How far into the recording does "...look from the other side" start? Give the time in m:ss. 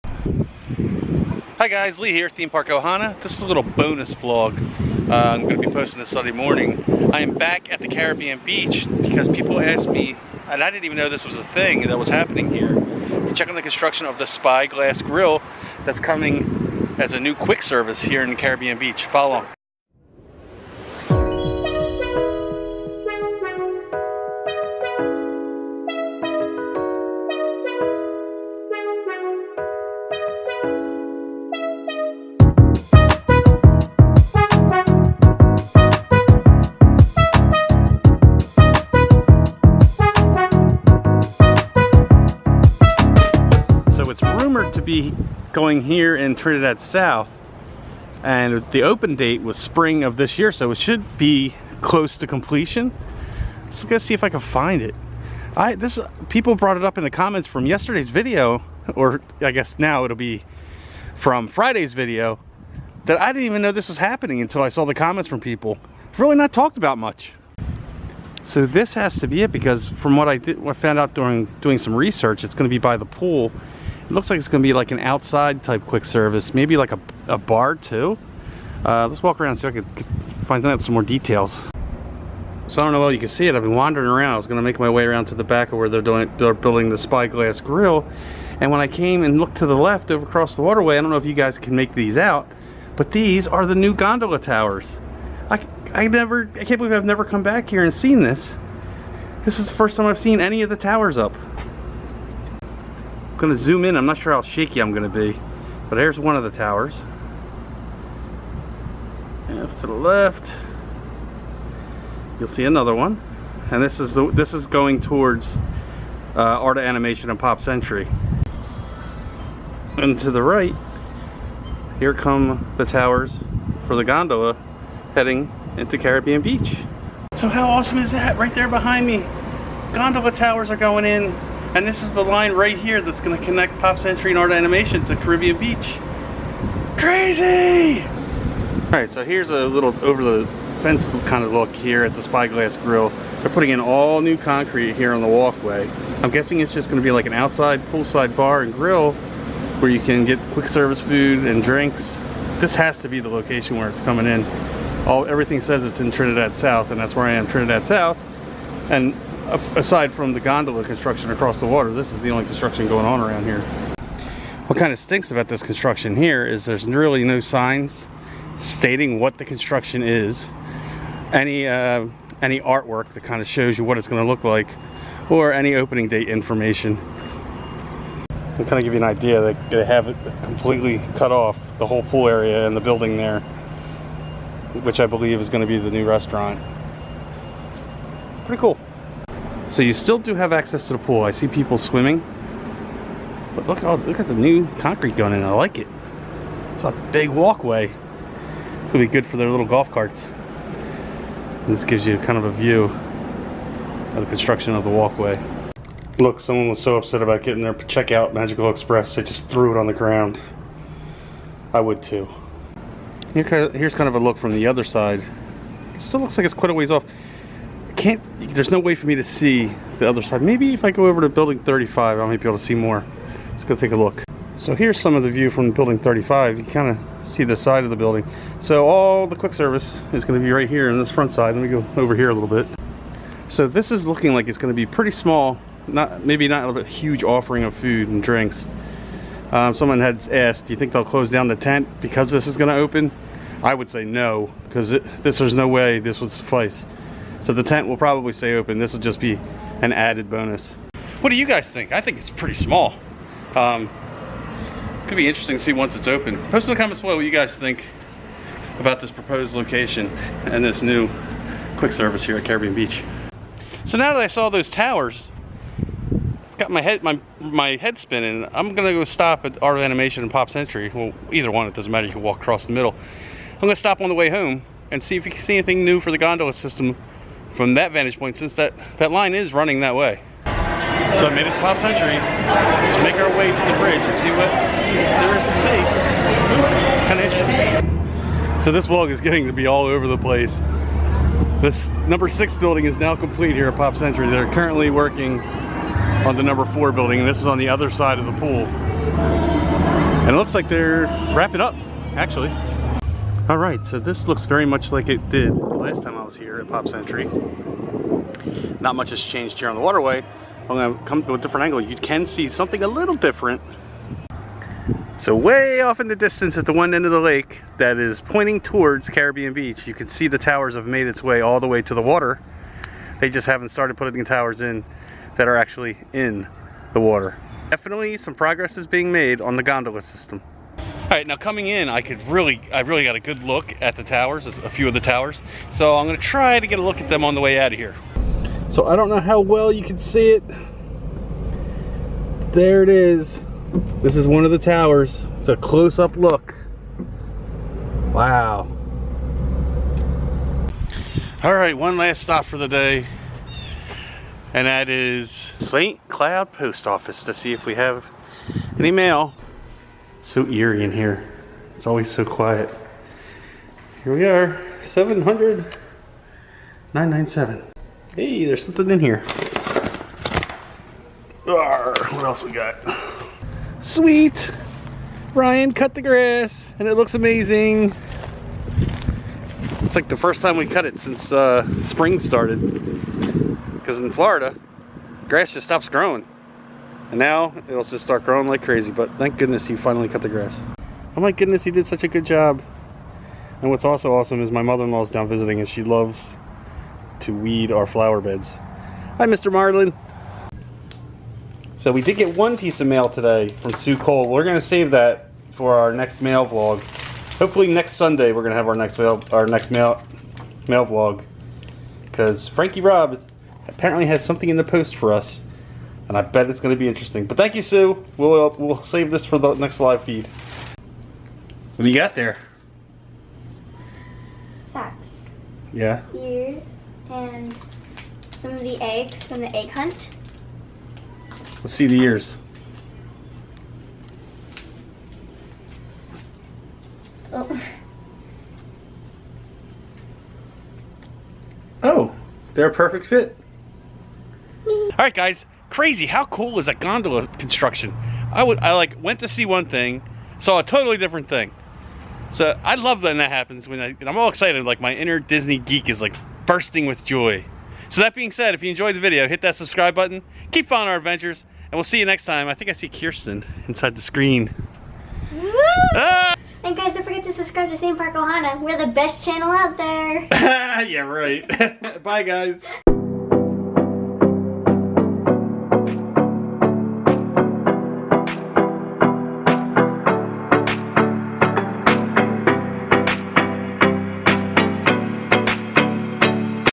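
3:34.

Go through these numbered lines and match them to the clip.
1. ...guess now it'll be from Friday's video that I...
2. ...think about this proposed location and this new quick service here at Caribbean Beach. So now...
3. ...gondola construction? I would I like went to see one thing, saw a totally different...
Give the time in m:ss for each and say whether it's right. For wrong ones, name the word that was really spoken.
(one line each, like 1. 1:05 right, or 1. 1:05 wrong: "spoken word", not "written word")
1. 0:59 right
2. 4:17 right
3. 7:26 right.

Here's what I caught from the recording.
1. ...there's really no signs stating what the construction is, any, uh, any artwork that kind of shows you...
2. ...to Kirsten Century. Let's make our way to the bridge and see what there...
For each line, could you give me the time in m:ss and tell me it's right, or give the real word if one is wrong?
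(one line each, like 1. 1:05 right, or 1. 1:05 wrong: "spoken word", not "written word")
1. 2:46 right
2. 4:41 wrong: "Pop", not "Kirsten".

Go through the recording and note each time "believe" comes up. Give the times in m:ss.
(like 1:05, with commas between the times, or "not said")
1:36, 3:05.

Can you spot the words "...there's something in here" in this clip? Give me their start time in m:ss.
6:08.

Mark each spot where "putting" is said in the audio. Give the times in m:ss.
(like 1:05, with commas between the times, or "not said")
2:23, 5:23.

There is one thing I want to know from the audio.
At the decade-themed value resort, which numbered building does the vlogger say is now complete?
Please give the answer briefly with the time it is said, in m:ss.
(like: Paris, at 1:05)
6, at 4:52.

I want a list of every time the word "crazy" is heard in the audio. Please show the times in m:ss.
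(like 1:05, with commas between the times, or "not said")
2:16, 6:28, 7:25.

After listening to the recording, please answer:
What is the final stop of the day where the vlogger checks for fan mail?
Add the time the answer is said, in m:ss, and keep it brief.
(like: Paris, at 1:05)
St. Cloud Post Office, at 5:55.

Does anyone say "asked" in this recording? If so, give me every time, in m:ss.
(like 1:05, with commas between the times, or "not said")
0:09, 4:00.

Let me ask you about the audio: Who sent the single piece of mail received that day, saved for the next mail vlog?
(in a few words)
Sue Cole.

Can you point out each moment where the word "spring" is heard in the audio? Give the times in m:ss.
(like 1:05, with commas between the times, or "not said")
0:49, 6:21.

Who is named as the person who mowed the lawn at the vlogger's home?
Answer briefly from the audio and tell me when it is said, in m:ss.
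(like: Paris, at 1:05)
Ryan, at 6:15.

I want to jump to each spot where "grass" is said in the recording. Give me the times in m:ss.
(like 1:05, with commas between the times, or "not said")
6:16, 6:25, 6:30.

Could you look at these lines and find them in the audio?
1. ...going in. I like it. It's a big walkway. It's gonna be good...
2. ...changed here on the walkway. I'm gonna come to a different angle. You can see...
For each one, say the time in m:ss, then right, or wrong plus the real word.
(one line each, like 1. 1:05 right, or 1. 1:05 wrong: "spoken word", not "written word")
1. 3:15 right
2. 5:09 wrong: "waterway", not "walkway".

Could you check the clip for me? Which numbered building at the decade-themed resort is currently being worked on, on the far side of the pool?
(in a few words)
4.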